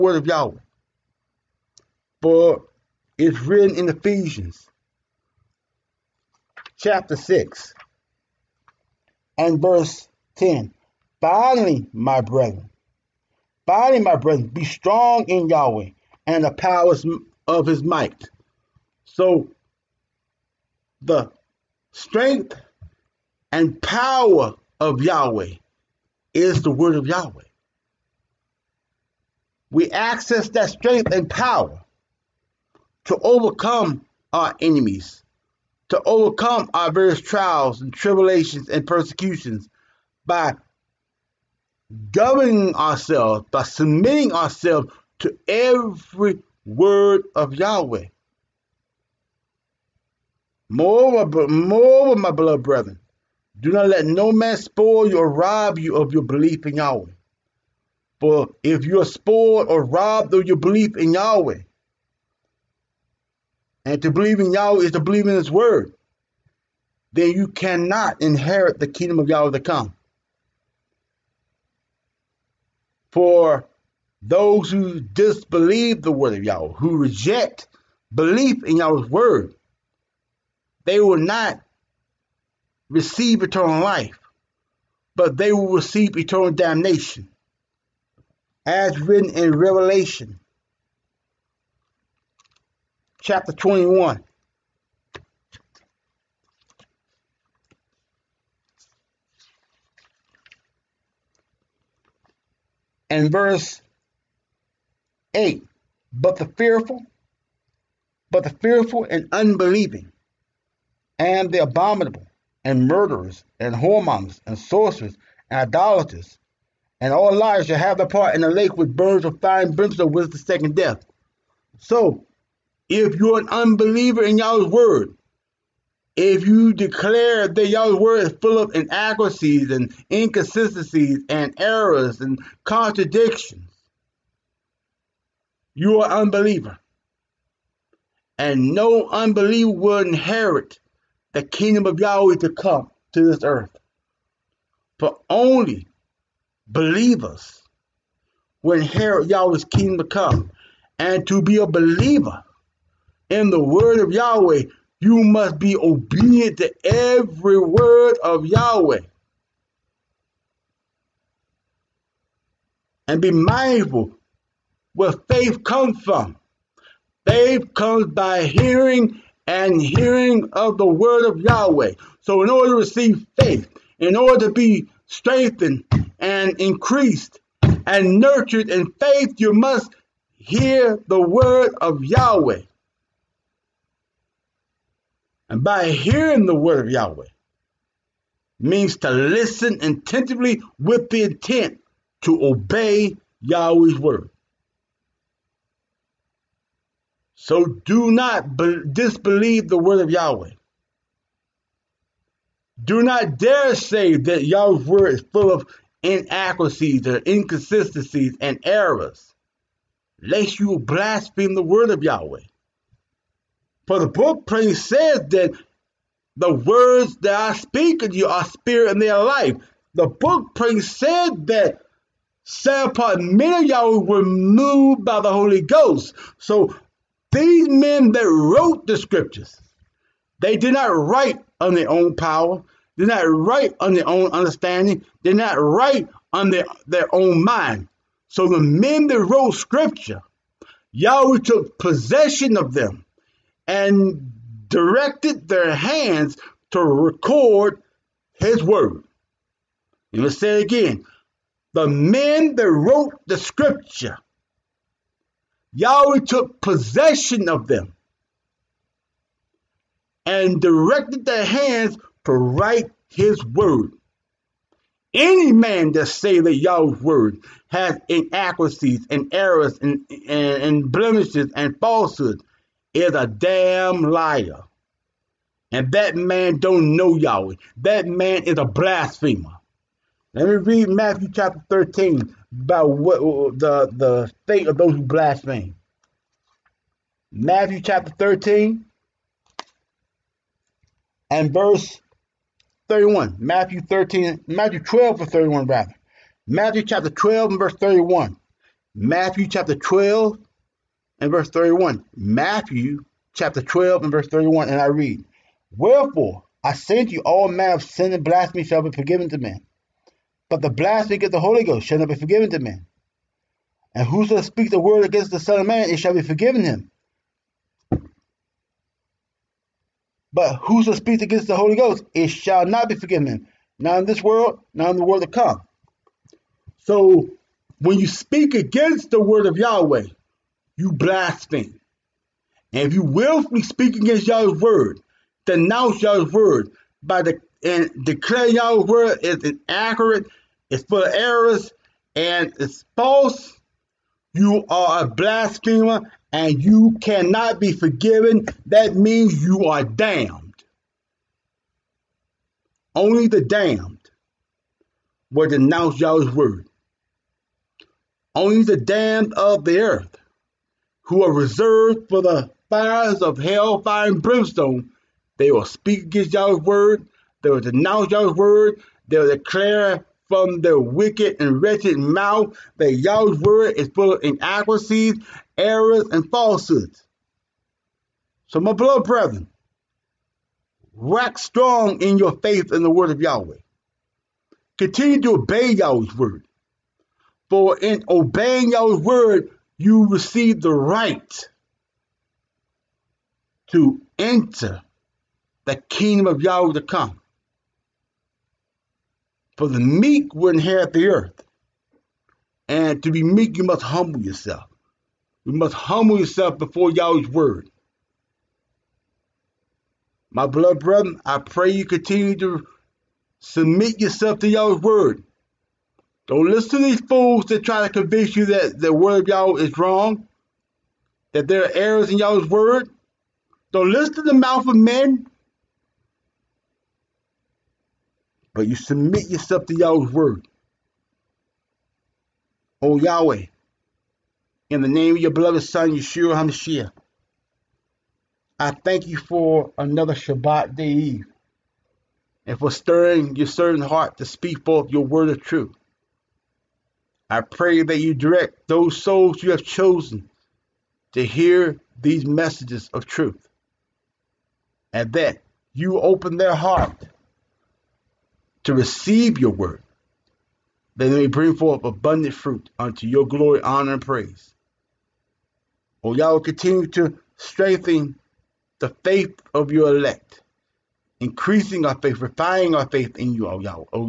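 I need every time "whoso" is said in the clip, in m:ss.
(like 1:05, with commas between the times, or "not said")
5:14, 5:20.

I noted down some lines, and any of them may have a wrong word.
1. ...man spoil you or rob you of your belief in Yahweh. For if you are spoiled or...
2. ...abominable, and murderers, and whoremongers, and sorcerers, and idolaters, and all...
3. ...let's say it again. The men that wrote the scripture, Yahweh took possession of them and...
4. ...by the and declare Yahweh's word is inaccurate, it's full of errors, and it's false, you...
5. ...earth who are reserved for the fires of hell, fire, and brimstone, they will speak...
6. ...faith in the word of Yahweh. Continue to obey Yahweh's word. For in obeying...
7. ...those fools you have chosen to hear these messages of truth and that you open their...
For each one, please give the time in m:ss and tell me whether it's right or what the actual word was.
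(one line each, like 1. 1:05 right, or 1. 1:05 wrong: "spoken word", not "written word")
1. 0:54 right
2. 1:51 right
3. 4:10 right
4. 5:37 right
5. 5:59 right
6. 6:22 right
7. 7:28 wrong: "souls", not "fools".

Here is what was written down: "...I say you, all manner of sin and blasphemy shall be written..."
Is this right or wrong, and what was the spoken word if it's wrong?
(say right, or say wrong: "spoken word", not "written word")
wrong: "forgiven", not "written".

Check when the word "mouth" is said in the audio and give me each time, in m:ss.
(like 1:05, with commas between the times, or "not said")
6:11, 7:04.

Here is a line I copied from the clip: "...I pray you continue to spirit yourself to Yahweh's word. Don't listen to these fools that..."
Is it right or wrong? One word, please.
wrong.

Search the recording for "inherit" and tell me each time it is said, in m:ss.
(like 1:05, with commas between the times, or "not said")
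1:08, 2:19, 2:28, 6:40.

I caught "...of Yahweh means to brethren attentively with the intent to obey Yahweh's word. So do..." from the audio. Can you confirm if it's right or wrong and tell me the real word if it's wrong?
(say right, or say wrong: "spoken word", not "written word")
wrong: "listen", not "brethren".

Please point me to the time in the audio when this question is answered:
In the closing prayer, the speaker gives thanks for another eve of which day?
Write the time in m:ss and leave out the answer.
7:20.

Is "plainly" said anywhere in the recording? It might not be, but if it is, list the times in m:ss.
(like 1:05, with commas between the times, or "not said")
3:34, 3:40.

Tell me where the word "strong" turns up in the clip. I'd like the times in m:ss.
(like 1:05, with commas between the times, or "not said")
0:14, 6:21.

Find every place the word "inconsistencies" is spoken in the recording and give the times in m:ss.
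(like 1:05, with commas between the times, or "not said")
2:10, 3:27.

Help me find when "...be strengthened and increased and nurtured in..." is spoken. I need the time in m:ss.
2:54.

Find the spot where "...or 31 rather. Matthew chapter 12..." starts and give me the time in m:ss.
4:55.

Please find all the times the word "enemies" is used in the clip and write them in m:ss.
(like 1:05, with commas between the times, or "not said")
0:34.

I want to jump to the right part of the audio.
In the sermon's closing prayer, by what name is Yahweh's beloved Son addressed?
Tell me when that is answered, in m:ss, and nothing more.
7:15.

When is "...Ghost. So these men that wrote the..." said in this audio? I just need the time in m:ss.
3:45.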